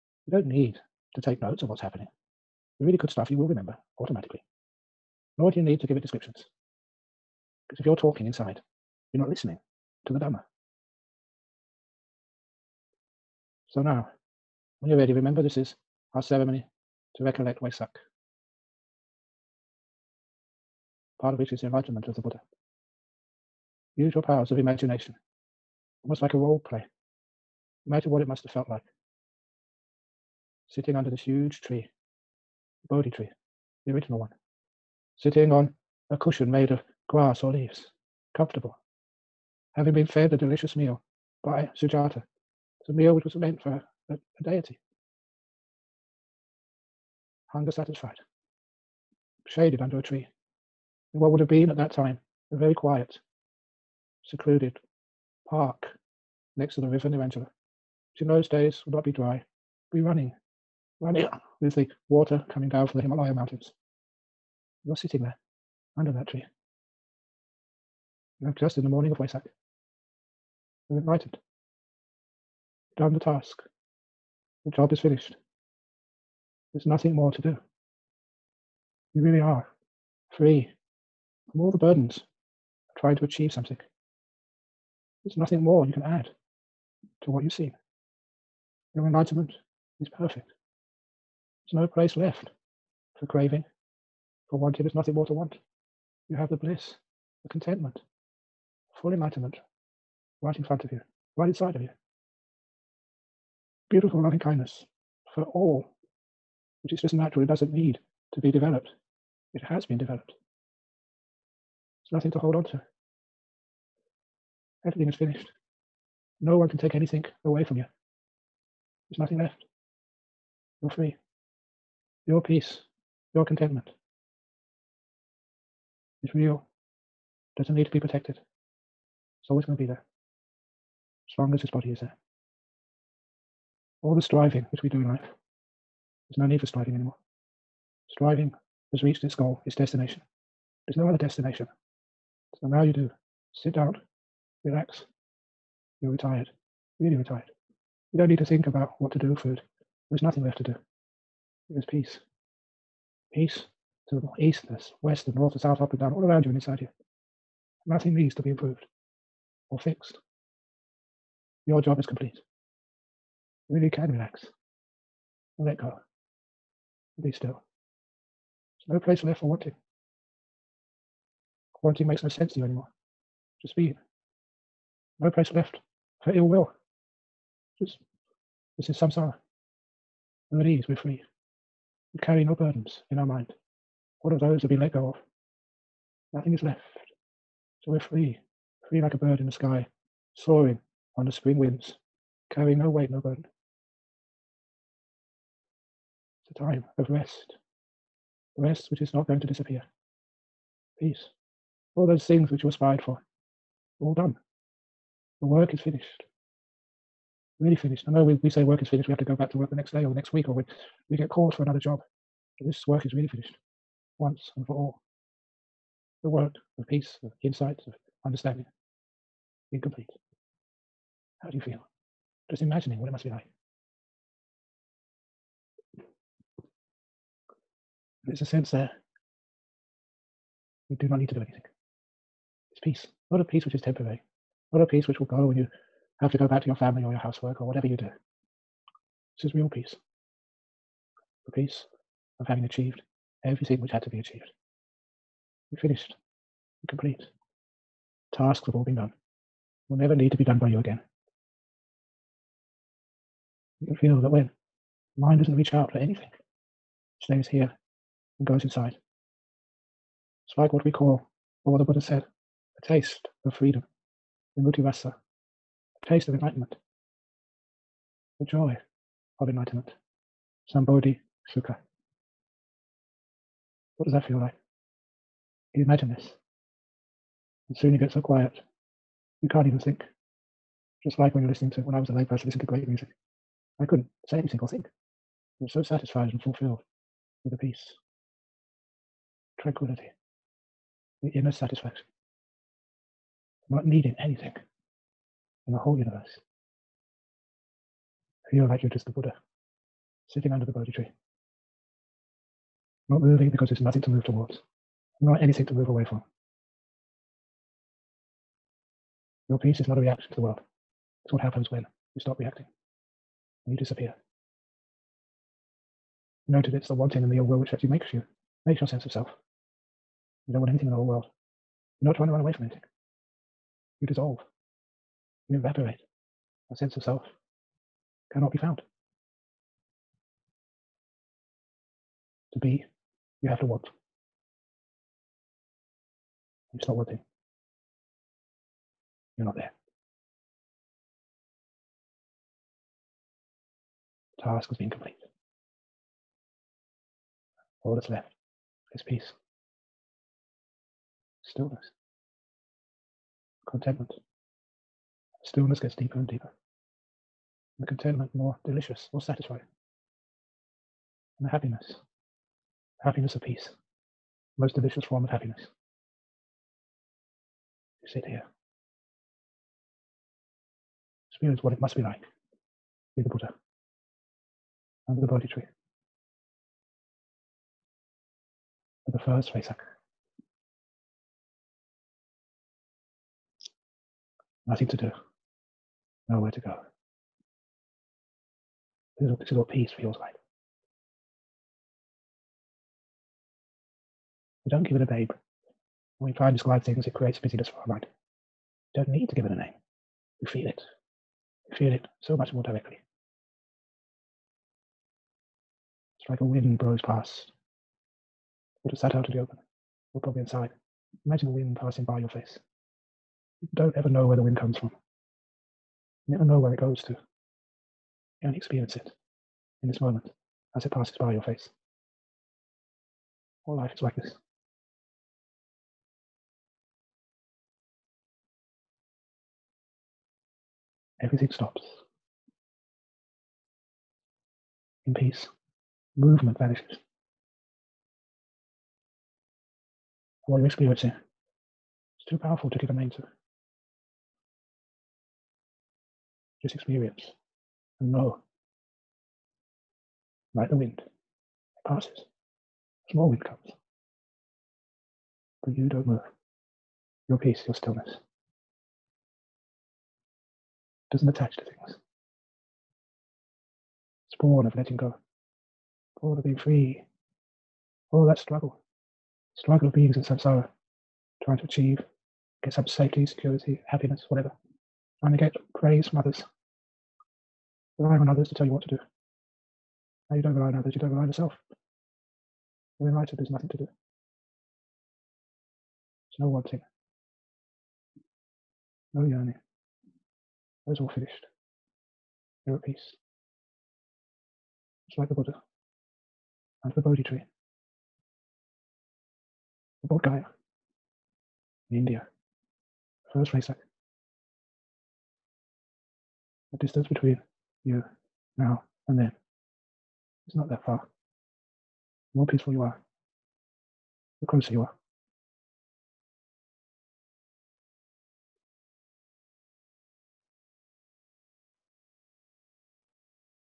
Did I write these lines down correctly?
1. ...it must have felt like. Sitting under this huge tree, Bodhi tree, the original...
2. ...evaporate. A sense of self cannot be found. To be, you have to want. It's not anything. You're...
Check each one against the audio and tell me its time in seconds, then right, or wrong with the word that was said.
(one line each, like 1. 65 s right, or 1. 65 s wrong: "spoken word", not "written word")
1. 28 s right
2. 325 s wrong: "wanting", not "anything".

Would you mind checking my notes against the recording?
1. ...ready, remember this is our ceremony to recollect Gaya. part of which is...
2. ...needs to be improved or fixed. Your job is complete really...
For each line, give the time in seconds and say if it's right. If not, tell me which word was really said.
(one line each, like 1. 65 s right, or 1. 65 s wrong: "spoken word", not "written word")
1. 14 s wrong: "Vesak", not "Gaya"
2. 158 s right.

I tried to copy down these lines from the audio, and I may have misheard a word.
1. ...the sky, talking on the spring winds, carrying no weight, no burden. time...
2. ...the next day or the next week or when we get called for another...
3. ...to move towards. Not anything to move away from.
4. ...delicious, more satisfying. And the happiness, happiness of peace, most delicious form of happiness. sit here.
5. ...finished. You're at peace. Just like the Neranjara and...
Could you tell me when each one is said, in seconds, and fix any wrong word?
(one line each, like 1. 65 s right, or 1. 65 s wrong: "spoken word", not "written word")
1. 189 s wrong: "soaring", not "talking"
2. 209 s right
3. 304 s right
4. 358 s right
5. 491 s wrong: "Buddha", not "Neranjara".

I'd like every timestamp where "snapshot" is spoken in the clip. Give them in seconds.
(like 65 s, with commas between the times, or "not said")
not said.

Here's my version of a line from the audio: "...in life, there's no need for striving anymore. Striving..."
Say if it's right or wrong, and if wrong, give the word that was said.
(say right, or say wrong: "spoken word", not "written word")
right.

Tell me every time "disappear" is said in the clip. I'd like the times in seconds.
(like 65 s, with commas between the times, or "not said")
199 s, 313 s.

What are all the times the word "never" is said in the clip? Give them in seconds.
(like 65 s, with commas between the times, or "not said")
249 s, 416 s.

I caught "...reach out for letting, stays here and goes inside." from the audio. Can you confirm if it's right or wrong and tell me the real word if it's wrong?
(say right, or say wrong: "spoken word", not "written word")
wrong: "anything", not "letting".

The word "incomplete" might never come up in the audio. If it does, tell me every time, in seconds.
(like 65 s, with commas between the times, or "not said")
219 s.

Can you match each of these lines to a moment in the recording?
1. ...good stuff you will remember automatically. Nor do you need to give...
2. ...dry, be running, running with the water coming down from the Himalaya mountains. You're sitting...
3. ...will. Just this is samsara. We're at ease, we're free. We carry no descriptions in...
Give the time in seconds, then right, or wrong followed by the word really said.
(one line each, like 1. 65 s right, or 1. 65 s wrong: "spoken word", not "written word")
1. 2 s right
2. 59 s right
3. 176 s wrong: "burdens", not "descriptions".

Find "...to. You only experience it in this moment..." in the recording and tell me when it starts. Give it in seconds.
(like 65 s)
417 s.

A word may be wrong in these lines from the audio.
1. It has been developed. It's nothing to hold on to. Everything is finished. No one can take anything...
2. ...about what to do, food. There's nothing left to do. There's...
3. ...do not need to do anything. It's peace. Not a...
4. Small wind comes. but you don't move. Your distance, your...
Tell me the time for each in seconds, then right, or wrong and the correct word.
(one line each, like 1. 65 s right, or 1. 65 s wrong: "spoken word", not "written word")
1. 109 s right
2. 148 s right
3. 230 s right
4. 453 s wrong: "peace", not "distance".